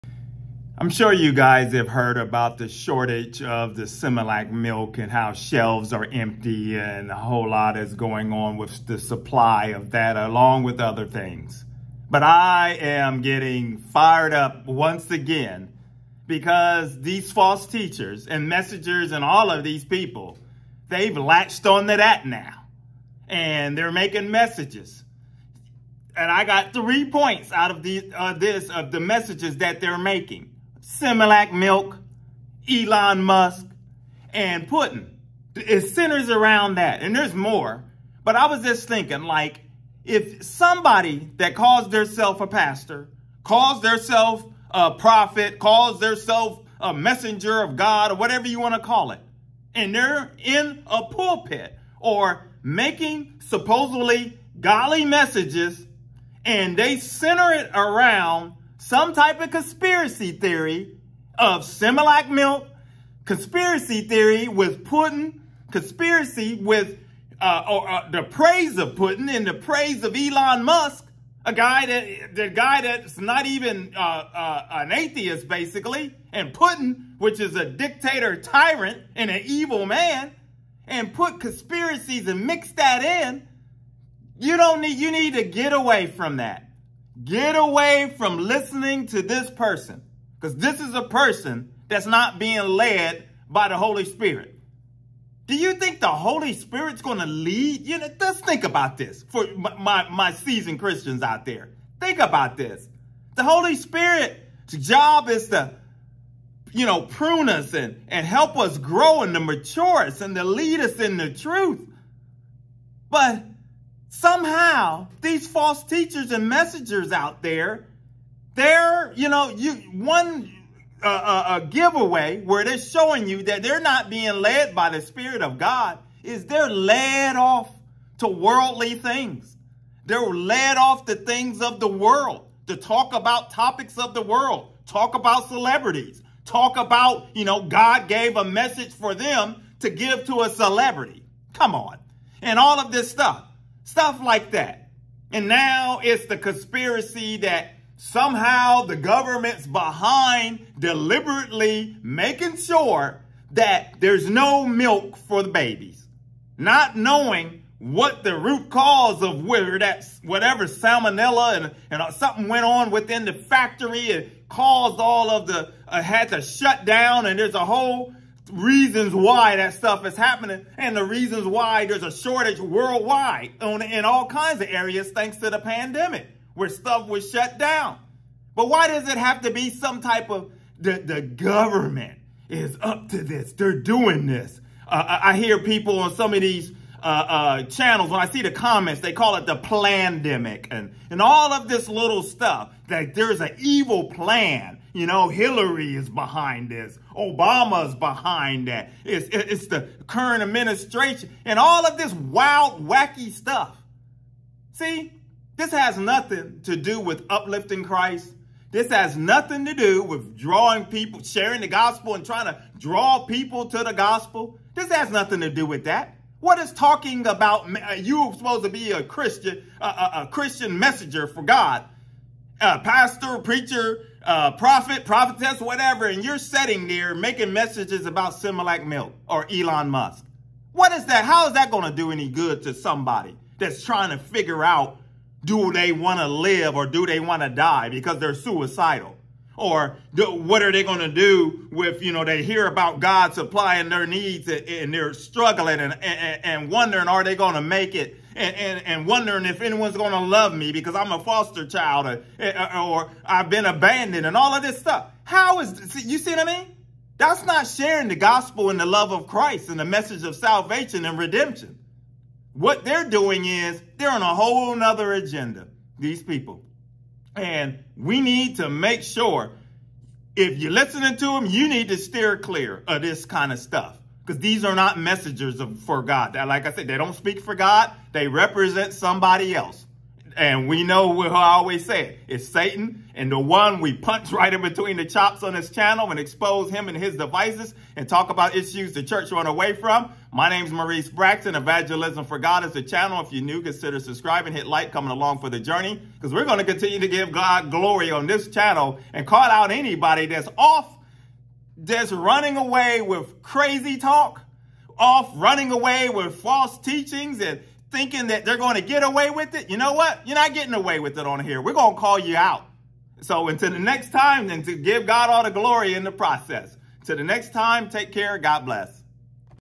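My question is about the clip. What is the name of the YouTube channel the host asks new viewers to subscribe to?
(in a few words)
Evangelism for God.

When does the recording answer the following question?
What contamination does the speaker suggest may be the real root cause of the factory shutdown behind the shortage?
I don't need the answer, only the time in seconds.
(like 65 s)
160 s.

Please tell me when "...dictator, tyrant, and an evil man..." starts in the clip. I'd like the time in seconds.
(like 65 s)
77 s.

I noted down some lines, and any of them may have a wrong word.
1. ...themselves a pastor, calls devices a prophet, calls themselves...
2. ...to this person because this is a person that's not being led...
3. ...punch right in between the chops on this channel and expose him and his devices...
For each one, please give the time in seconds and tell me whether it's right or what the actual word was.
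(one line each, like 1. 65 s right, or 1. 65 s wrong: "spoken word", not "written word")
1. 41 s wrong: "themselves", not "devices"
2. 89 s right
3. 283 s right.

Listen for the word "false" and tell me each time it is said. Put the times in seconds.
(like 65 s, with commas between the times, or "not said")
17 s, 115 s, 306 s.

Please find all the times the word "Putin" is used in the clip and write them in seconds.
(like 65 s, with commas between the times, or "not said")
34 s, 64 s, 68 s, 76 s.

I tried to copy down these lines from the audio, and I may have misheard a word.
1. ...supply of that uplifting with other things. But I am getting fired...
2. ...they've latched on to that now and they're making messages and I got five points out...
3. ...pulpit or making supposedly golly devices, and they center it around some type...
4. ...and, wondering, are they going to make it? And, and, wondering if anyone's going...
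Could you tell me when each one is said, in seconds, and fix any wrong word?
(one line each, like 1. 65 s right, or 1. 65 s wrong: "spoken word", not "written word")
1. 8 s wrong: "along", not "uplifting"
2. 20 s wrong: "three", not "five"
3. 51 s wrong: "messages", not "devices"
4. 246 s right.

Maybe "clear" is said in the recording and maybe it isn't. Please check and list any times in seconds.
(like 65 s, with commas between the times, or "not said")
272 s.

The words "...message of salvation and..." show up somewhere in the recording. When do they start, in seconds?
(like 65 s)
259 s.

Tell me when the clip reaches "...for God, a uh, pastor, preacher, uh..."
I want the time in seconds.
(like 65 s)
221 s.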